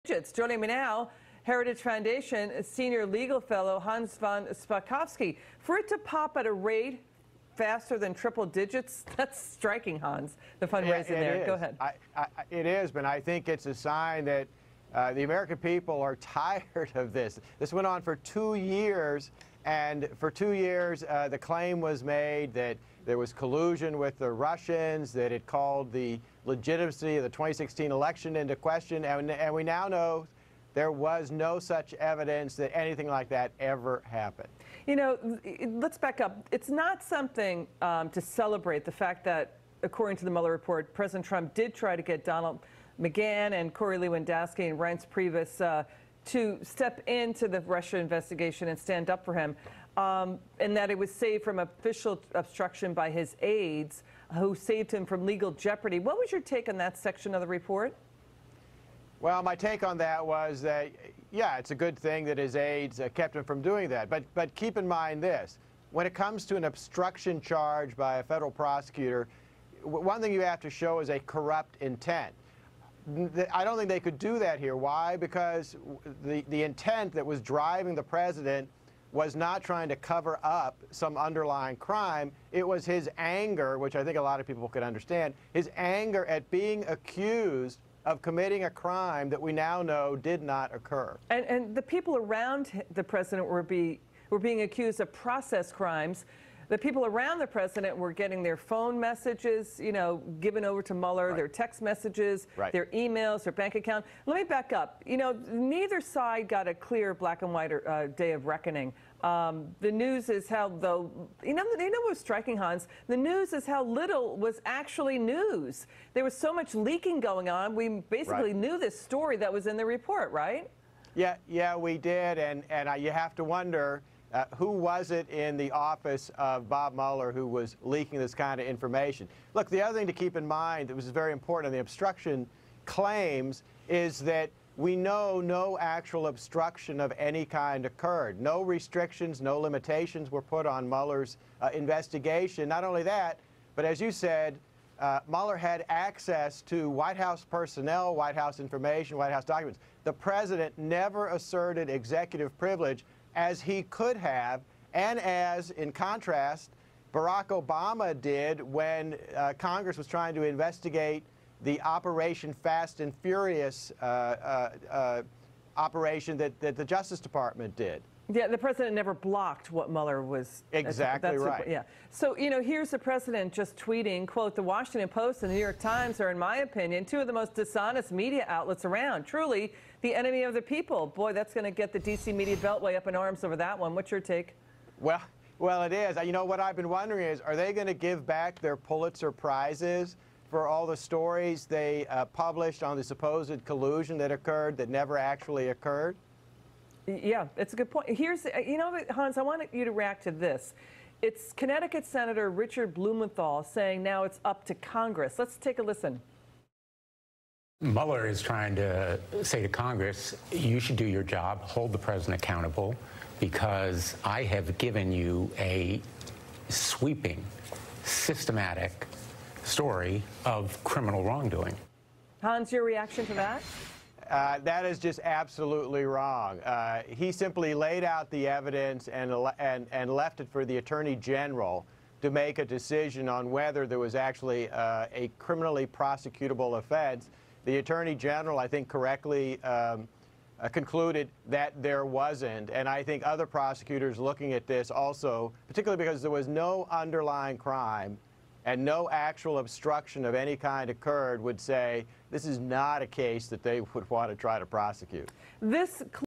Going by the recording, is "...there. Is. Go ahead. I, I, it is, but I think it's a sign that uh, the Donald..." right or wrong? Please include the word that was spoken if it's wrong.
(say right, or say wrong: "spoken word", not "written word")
wrong: "American", not "Donald".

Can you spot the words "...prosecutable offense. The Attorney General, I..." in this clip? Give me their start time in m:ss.
3:55.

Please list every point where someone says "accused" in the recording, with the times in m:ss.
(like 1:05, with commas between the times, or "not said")
1:26, 1:34.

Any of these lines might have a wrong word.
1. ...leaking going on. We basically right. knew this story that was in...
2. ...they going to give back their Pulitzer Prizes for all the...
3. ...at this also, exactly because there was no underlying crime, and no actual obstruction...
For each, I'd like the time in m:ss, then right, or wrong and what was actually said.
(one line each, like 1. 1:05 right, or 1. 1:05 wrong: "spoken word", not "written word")
1. 1:56 right
2. 3:07 right
3. 4:04 wrong: "particularly", not "exactly".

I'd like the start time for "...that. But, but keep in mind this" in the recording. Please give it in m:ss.
1:03.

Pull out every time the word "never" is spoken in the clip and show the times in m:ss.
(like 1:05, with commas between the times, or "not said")
2:30, 2:48, 3:14.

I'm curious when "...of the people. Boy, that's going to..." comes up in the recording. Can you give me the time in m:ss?
3:00.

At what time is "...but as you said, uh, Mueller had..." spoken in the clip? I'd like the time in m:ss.
2:23.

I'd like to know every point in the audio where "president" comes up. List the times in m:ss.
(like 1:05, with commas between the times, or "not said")
0:40, 1:18, 1:33, 1:37, 2:30, 2:48, 2:52, 3:31.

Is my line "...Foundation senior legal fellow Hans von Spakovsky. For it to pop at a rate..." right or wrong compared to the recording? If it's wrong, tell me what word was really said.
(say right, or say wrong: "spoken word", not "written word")
right.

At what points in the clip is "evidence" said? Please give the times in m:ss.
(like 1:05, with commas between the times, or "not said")
0:31, 3:48.